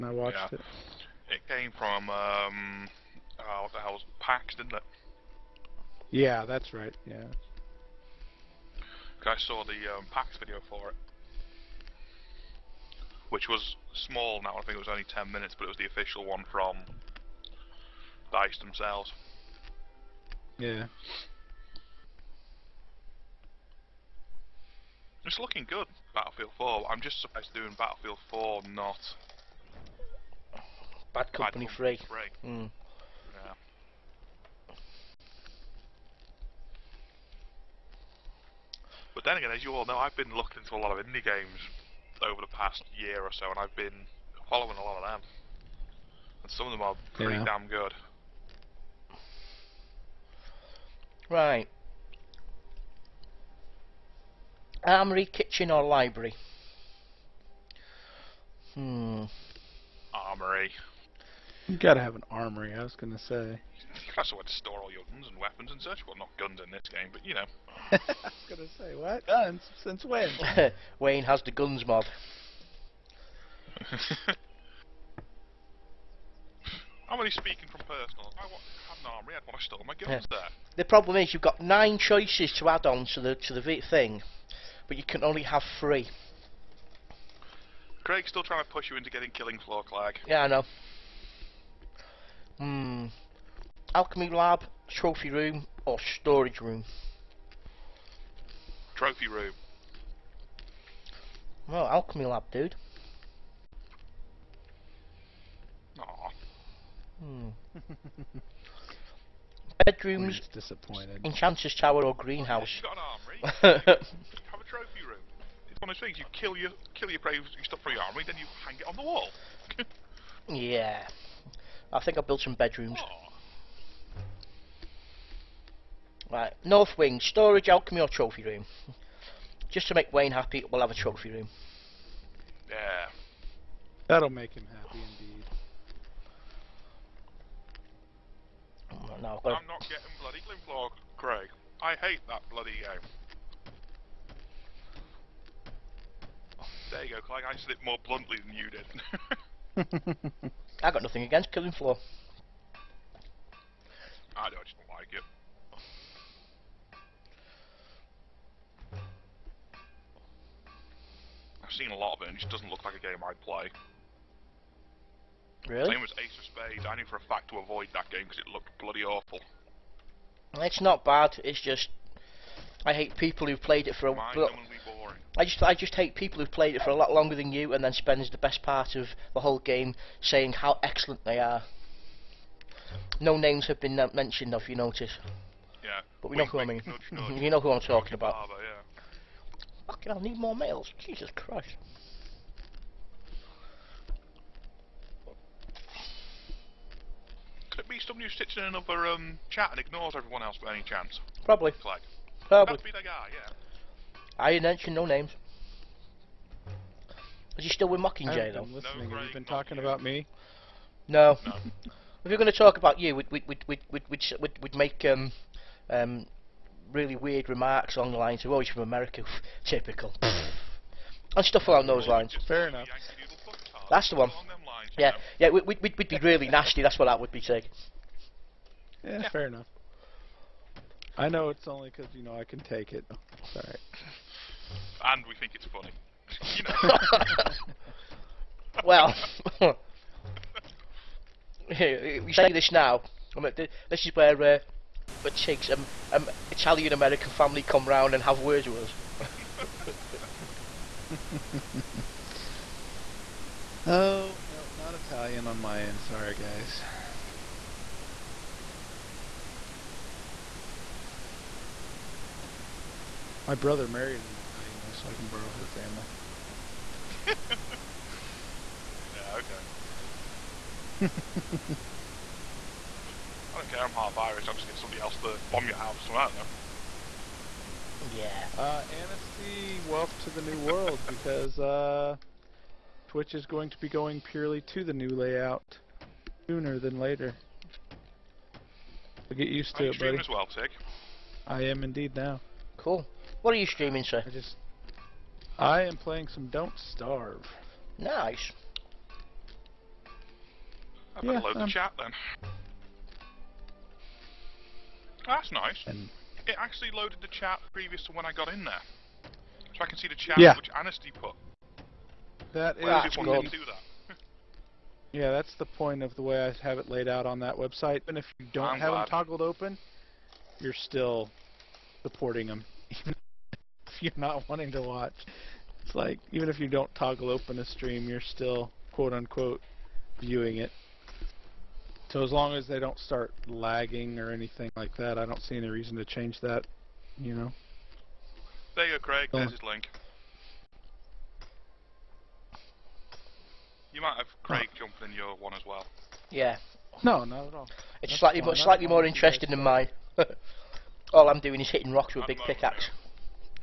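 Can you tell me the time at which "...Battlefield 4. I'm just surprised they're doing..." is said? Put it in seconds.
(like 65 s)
26 s.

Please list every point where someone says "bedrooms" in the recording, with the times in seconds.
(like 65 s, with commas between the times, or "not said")
109 s, 122 s.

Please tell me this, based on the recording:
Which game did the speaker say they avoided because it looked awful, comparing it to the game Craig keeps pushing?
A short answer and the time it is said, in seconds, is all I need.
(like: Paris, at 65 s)
Ace of Spades, at 166 s.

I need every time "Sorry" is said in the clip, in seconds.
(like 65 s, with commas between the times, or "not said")
233 s, 256 s.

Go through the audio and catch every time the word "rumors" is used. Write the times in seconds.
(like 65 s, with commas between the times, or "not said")
not said.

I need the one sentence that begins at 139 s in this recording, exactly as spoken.
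no, I'm, I'm not getting bloody Glimplog, Craig.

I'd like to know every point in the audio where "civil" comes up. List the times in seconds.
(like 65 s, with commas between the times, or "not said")
not said.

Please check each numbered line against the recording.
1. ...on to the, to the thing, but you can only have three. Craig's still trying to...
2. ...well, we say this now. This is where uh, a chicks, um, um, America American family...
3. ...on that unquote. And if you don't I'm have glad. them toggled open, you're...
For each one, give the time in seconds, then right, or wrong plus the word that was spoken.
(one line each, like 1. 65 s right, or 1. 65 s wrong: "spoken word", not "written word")
1. 82 s right
2. 238 s wrong: "Italian", not "America"
3. 317 s wrong: "website", not "unquote".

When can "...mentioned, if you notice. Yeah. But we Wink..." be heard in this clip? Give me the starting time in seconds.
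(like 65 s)
184 s.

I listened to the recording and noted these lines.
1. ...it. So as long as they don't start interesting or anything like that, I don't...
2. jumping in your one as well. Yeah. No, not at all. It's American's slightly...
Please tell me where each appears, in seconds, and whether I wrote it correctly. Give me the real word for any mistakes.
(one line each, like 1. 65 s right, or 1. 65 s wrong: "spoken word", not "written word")
1. 330 s wrong: "lagging", not "interesting"
2. 344 s wrong: "That", not "American".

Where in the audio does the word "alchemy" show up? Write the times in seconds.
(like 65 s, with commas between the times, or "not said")
93 s, 101 s, 127 s.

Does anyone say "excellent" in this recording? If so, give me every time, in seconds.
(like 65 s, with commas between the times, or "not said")
180 s.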